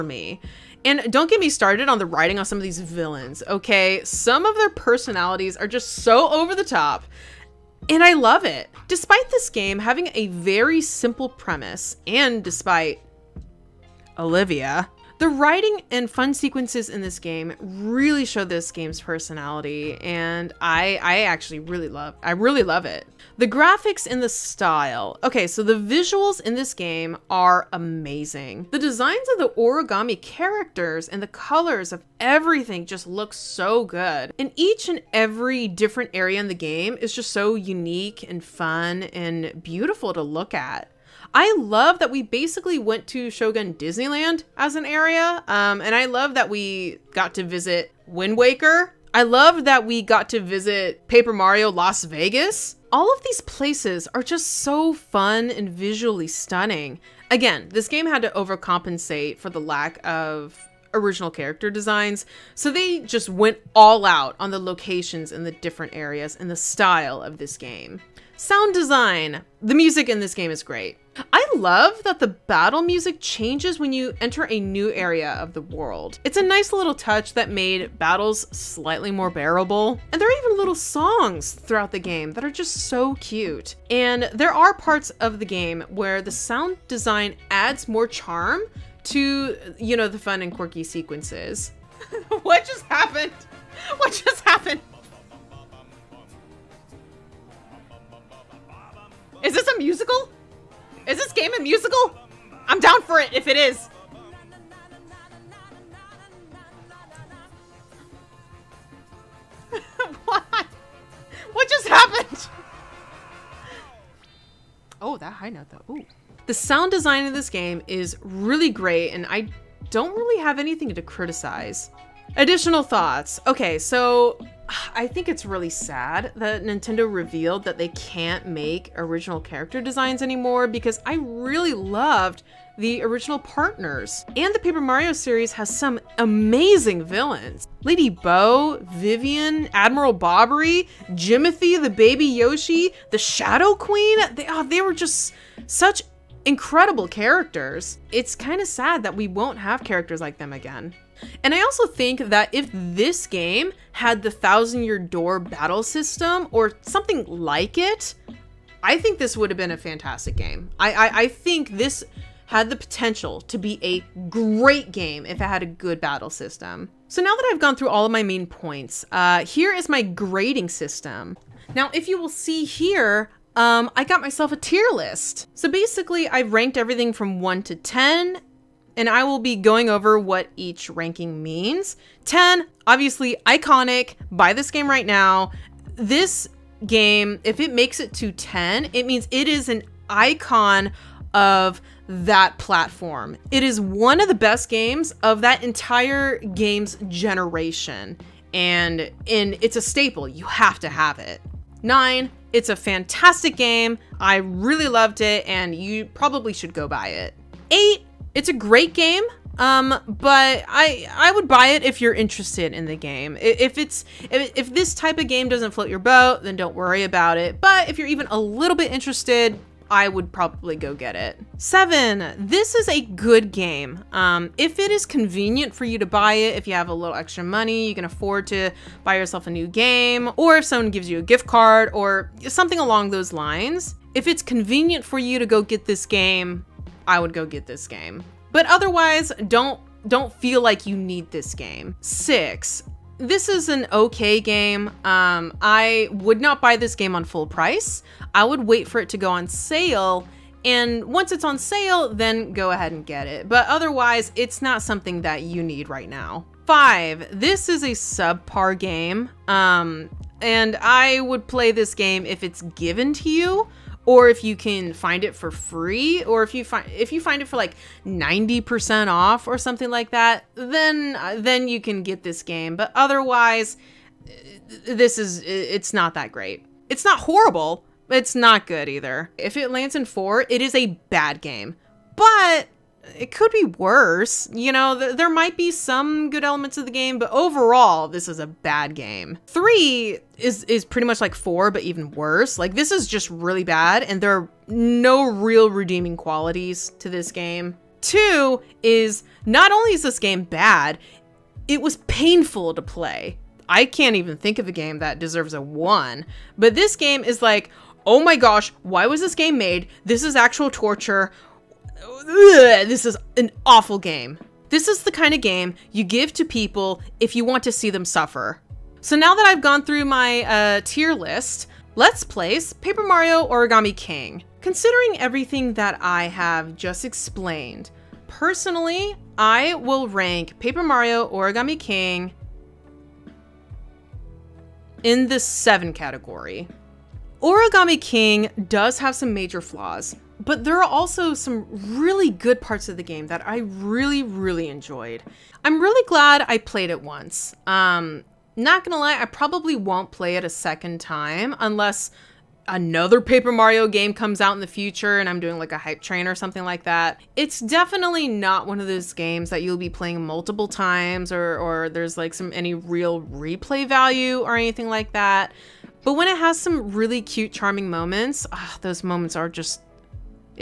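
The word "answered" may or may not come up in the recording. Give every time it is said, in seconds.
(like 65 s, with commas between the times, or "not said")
not said.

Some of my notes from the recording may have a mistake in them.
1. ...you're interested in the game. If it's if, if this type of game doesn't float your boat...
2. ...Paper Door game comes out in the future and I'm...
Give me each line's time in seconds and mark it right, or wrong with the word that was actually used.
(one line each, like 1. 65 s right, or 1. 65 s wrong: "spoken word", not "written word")
1. 212 s right
2. 353 s wrong: "Mario", not "Door".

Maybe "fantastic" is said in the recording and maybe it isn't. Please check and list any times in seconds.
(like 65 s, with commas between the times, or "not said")
159 s, 202 s.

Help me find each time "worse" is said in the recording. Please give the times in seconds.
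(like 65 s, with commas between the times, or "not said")
283 s, 292 s.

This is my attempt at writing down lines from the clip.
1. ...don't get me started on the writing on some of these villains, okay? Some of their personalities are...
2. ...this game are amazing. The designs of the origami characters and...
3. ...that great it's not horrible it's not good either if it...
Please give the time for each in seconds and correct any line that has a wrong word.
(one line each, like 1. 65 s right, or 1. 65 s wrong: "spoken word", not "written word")
1. 1 s right
2. 26 s right
3. 276 s right.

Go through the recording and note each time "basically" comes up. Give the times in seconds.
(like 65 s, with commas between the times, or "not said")
42 s, 175 s.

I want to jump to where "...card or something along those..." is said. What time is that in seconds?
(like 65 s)
231 s.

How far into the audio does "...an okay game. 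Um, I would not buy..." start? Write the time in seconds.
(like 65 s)
243 s.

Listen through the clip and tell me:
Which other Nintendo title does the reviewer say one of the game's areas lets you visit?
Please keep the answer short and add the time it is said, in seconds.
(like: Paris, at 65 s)
Wind Waker, at 48 s.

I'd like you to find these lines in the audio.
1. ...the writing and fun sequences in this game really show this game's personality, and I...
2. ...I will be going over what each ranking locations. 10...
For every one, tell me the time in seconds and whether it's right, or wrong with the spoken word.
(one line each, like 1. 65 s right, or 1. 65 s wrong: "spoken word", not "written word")
1. 15 s right
2. 179 s wrong: "means", not "locations".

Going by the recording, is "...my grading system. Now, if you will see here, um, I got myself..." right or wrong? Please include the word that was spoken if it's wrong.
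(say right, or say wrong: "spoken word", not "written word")
right.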